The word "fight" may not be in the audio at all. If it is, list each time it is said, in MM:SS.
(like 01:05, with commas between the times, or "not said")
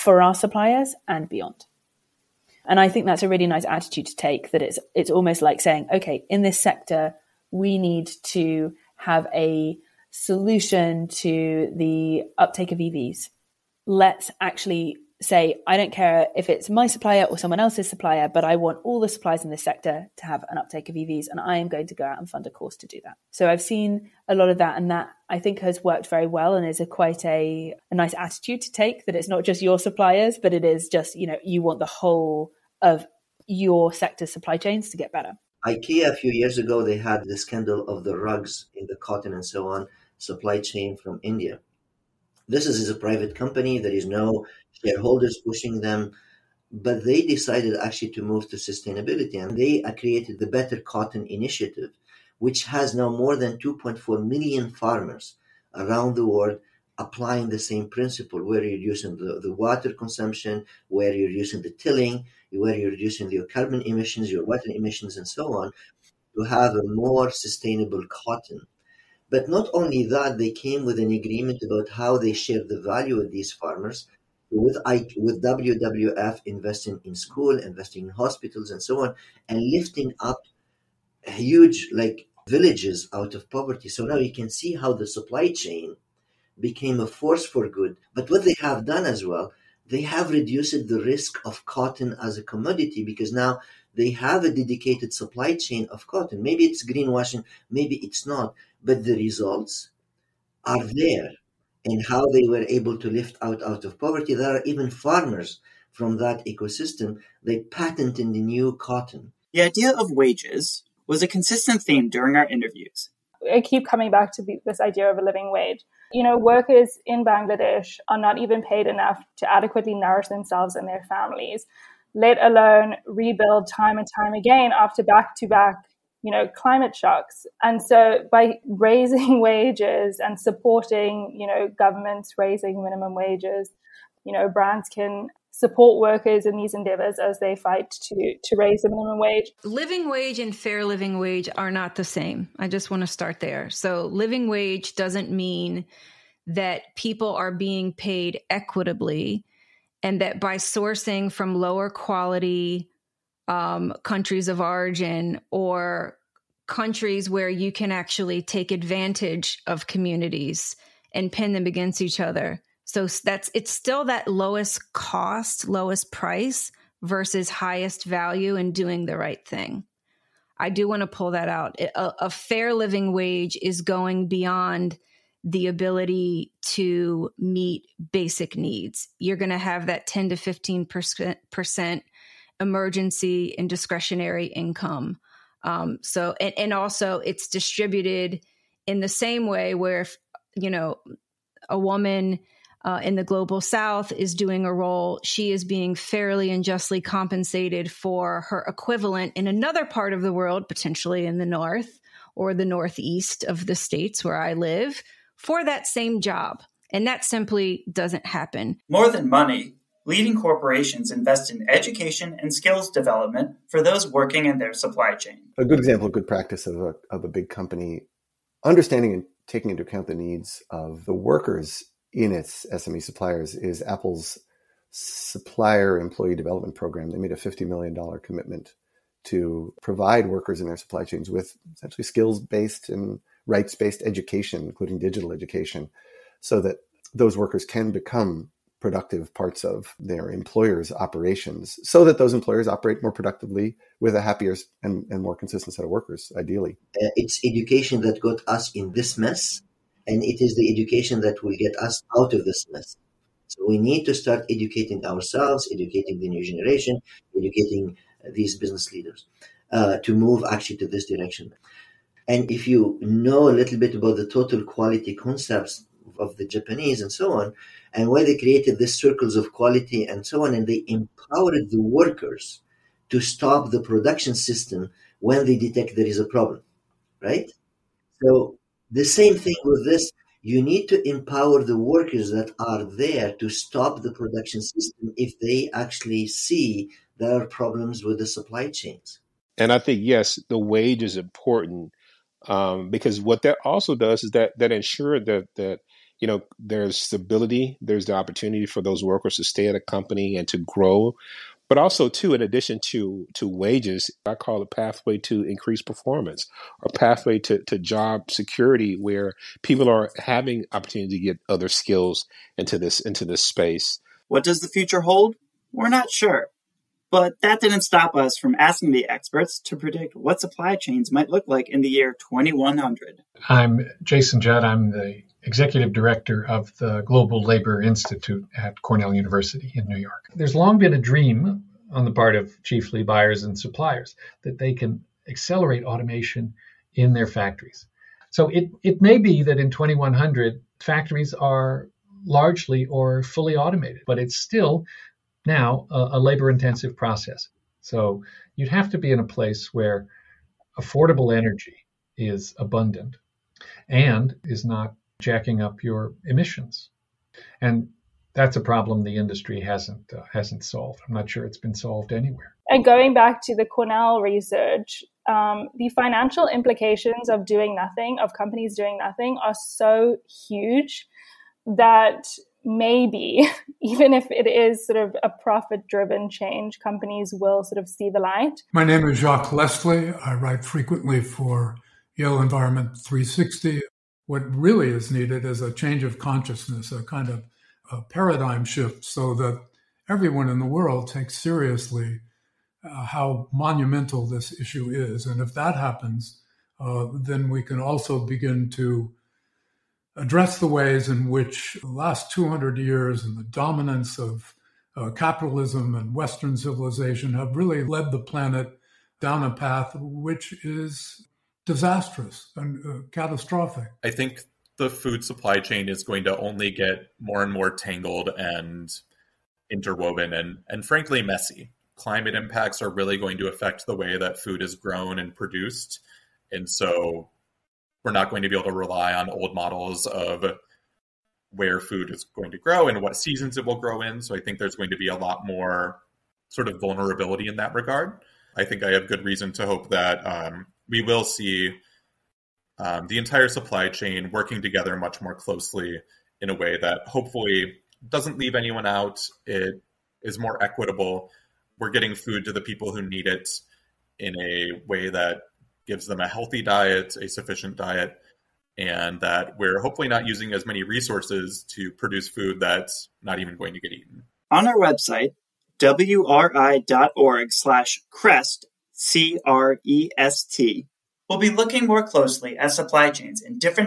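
02:17.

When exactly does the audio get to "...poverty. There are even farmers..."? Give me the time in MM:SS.
01:43.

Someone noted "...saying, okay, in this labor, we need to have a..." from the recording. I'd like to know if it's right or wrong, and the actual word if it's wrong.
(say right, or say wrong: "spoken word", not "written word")
wrong: "sector", not "labor".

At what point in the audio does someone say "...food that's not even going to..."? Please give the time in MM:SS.
07:42.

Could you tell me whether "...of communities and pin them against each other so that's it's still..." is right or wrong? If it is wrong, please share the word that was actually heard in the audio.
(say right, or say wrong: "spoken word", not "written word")
right.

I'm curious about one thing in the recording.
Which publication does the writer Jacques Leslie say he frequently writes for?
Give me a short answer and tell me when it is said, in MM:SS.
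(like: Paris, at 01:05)
Yale Environment 360, at 06:22.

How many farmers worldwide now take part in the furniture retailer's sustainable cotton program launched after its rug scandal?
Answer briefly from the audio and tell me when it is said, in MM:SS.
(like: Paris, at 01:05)
2.4 million, at 00:53.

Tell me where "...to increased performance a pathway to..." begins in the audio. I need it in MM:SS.
05:05.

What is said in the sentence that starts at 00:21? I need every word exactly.
And I am going to go out and fund a course to do that.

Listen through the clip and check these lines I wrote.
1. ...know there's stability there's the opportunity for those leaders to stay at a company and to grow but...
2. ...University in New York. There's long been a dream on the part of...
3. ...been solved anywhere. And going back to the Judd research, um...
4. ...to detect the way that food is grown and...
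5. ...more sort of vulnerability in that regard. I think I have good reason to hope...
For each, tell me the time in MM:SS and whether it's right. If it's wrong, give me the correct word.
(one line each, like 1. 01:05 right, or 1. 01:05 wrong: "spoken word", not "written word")
1. 04:56 wrong: "workers", not "leaders"
2. 05:29 right
3. 06:01 wrong: "Cornell", not "Judd"
4. 07:03 wrong: "affect", not "detect"
5. 07:15 right.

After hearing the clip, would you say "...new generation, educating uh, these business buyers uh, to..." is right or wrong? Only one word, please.
wrong.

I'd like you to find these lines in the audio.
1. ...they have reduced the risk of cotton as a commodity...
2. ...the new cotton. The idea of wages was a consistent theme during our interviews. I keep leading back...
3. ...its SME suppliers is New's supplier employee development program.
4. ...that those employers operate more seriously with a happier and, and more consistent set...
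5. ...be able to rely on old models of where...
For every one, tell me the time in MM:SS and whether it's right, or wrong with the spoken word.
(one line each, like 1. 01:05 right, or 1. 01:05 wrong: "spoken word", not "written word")
1. 01:29 right
2. 01:48 wrong: "coming", not "leading"
3. 03:42 wrong: "Apple", not "New"
4. 04:02 wrong: "productively", not "seriously"
5. 07:08 right.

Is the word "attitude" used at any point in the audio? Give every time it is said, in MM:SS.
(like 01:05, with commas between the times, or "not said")
00:03, 00:28.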